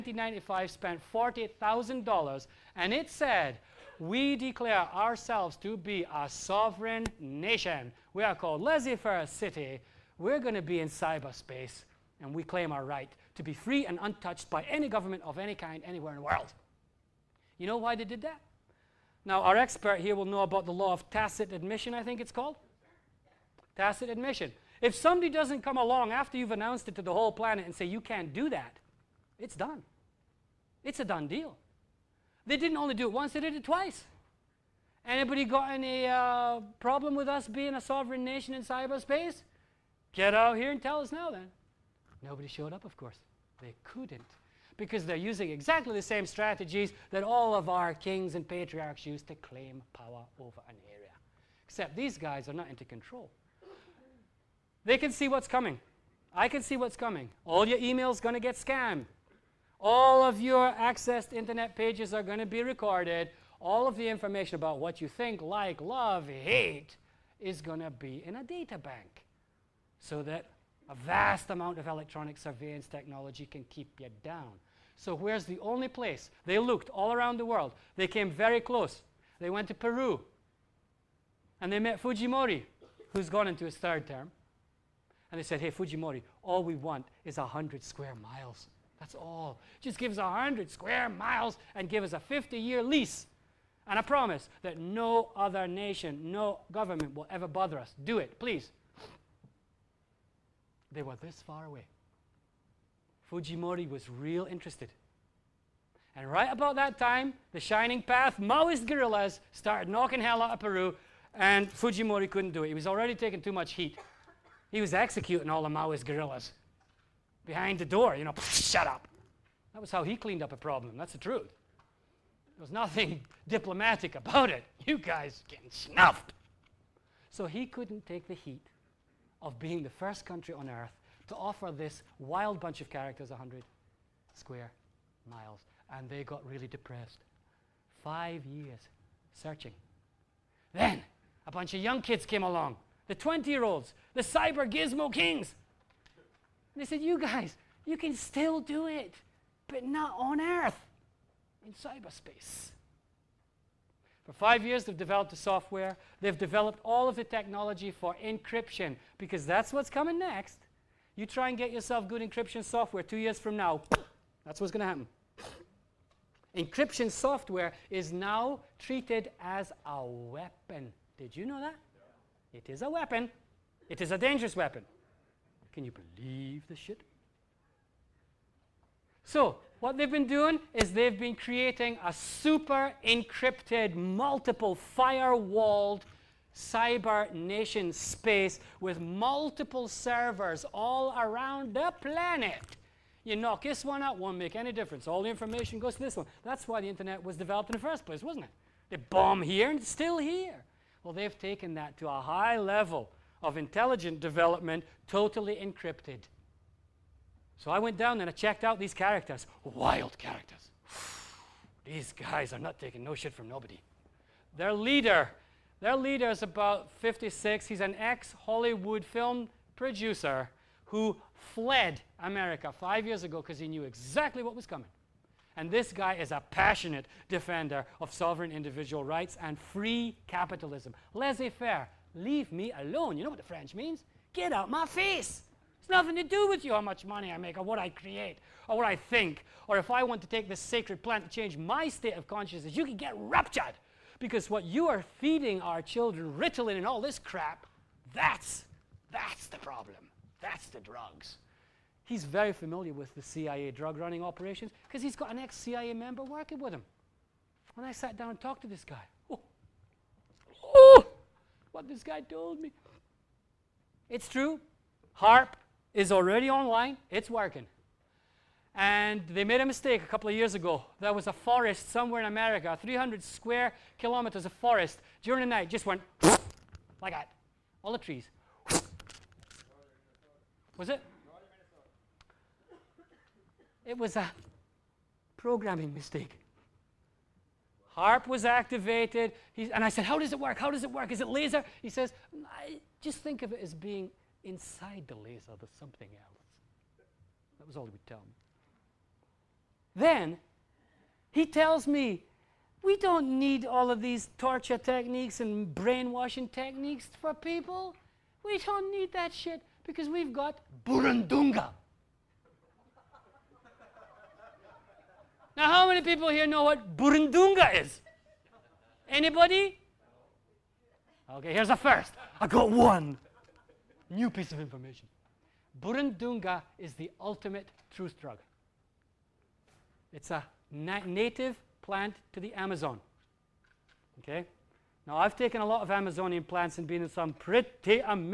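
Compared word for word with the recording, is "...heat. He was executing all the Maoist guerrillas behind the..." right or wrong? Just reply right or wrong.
right.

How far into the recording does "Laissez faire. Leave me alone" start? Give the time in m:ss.
3:51.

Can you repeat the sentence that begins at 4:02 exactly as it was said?
You can get raptured because what you are feeding our children, Ritalin and all this crap, that's, that's the problem.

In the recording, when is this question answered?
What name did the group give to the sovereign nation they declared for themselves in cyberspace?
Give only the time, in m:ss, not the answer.
0:08.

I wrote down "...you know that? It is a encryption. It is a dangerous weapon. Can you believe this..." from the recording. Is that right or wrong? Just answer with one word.
wrong.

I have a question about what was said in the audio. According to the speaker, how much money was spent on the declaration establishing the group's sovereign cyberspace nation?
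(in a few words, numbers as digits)
$40,000.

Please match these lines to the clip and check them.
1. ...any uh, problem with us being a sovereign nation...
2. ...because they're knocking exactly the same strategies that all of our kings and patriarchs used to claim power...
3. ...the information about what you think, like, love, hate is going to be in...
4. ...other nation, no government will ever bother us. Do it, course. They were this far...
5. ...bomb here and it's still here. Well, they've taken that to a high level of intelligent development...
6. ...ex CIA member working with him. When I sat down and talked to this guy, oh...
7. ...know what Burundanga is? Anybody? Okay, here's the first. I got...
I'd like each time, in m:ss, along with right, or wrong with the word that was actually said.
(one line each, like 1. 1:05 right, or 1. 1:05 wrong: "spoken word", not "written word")
1. 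0:35 right
2. 0:44 wrong: "using", not "knocking"
3. 1:03 right
4. 1:35 wrong: "please", not "course"
5. 3:18 right
6. 4:15 right
7. 5:16 right.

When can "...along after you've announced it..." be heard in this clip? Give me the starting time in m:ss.
0:25.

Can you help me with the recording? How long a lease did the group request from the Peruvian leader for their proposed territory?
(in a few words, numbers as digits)
50 years.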